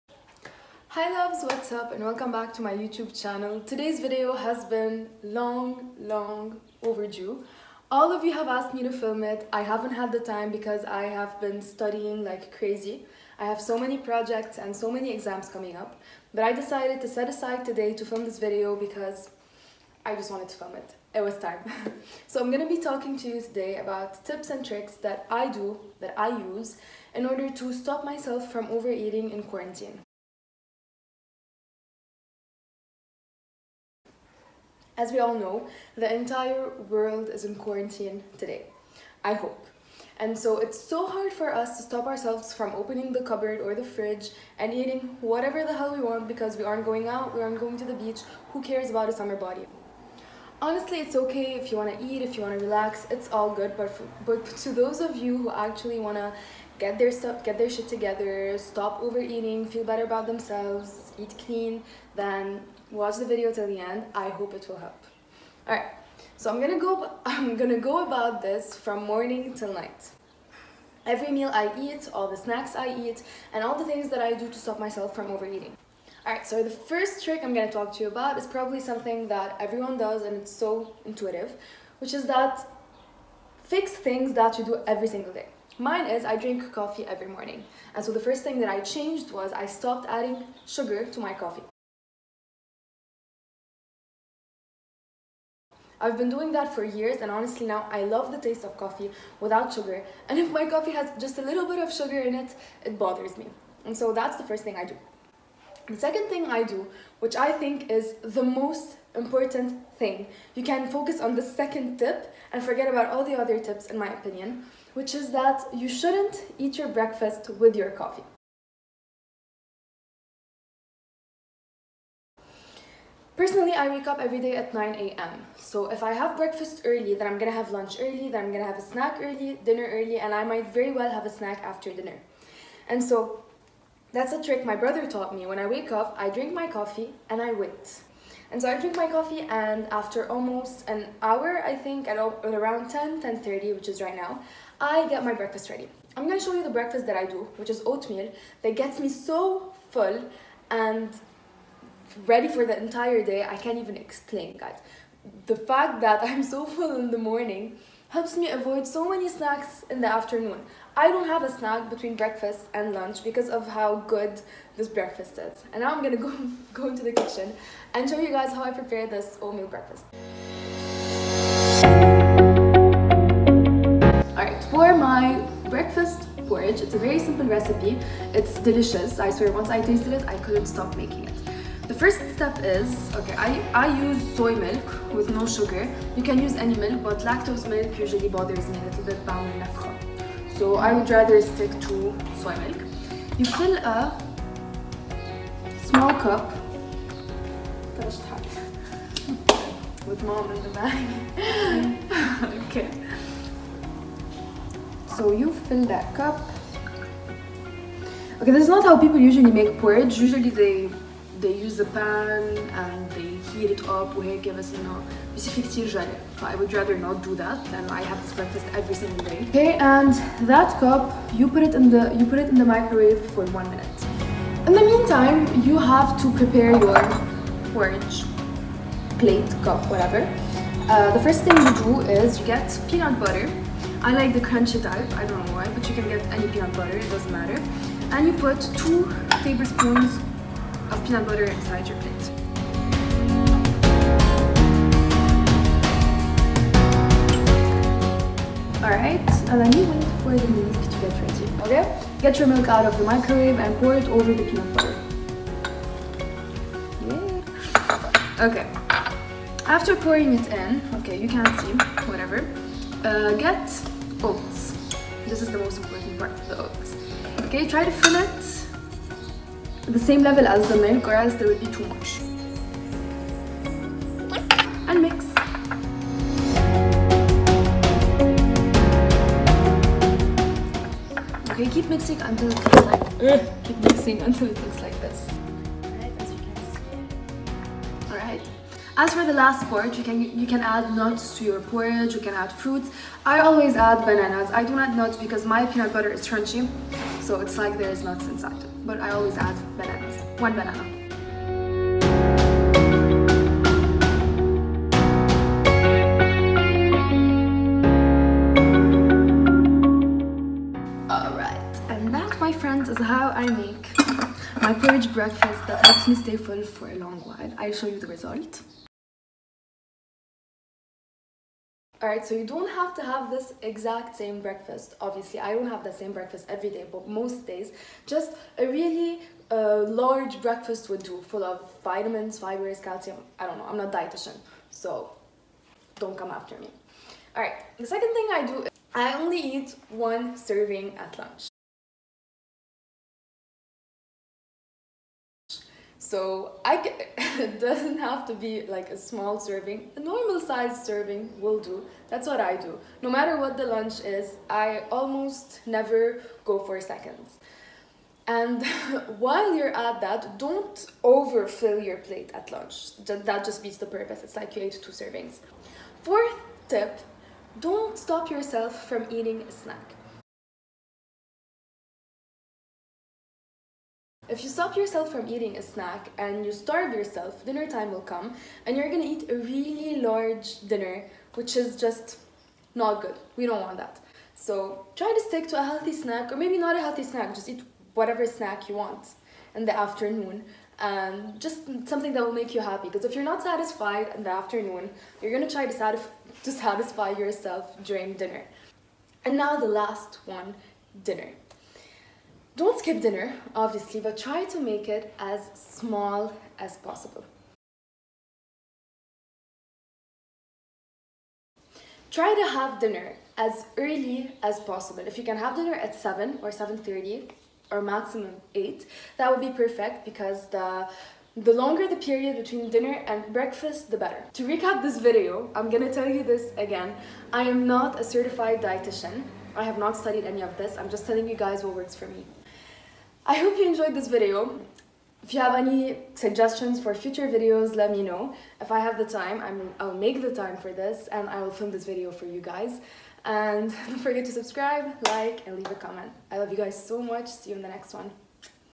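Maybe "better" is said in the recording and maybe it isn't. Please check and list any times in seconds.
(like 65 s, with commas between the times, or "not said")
59 s, 423 s.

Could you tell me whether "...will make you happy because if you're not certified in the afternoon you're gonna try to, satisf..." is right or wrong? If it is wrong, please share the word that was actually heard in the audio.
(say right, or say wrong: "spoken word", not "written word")
wrong: "satisfied", not "certified".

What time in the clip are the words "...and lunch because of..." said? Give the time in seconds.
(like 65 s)
162 s.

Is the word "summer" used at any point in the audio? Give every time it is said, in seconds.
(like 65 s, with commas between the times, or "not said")
49 s.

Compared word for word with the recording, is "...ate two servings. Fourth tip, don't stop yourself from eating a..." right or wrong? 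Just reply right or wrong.
right.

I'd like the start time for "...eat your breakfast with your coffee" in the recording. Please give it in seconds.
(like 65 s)
116 s.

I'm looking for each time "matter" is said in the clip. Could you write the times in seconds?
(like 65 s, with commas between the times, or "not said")
237 s, 353 s.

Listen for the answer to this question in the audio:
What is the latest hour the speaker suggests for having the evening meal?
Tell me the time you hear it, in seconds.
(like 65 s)
417 s.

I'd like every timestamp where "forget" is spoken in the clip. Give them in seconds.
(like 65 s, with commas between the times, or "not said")
112 s, 443 s.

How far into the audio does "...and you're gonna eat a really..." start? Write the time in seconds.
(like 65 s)
378 s.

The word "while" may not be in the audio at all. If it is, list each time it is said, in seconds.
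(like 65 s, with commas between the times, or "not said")
317 s, 359 s.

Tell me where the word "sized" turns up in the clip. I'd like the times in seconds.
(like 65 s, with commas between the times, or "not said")
350 s.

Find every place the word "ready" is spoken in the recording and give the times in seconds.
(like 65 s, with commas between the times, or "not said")
145 s, 152 s, 251 s.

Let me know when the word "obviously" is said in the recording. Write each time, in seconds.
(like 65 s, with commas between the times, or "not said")
324 s, 403 s.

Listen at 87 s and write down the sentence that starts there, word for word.
And so the first thing that I changed was I stopped adding sugar to my coffee.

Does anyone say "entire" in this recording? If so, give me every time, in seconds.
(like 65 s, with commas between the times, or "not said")
36 s, 152 s.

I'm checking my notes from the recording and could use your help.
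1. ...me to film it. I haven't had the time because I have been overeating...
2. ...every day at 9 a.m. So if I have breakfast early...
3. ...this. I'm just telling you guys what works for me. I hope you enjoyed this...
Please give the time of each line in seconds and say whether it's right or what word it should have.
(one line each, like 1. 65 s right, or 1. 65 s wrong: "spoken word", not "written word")
1. 8 s wrong: "studying", not "overeating"
2. 124 s right
3. 430 s right.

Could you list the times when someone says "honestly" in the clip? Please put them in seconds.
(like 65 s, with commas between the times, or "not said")
50 s, 97 s.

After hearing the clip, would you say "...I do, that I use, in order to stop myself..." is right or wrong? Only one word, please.
right.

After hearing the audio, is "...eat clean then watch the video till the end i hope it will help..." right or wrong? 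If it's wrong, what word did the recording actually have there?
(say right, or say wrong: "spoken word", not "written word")
right.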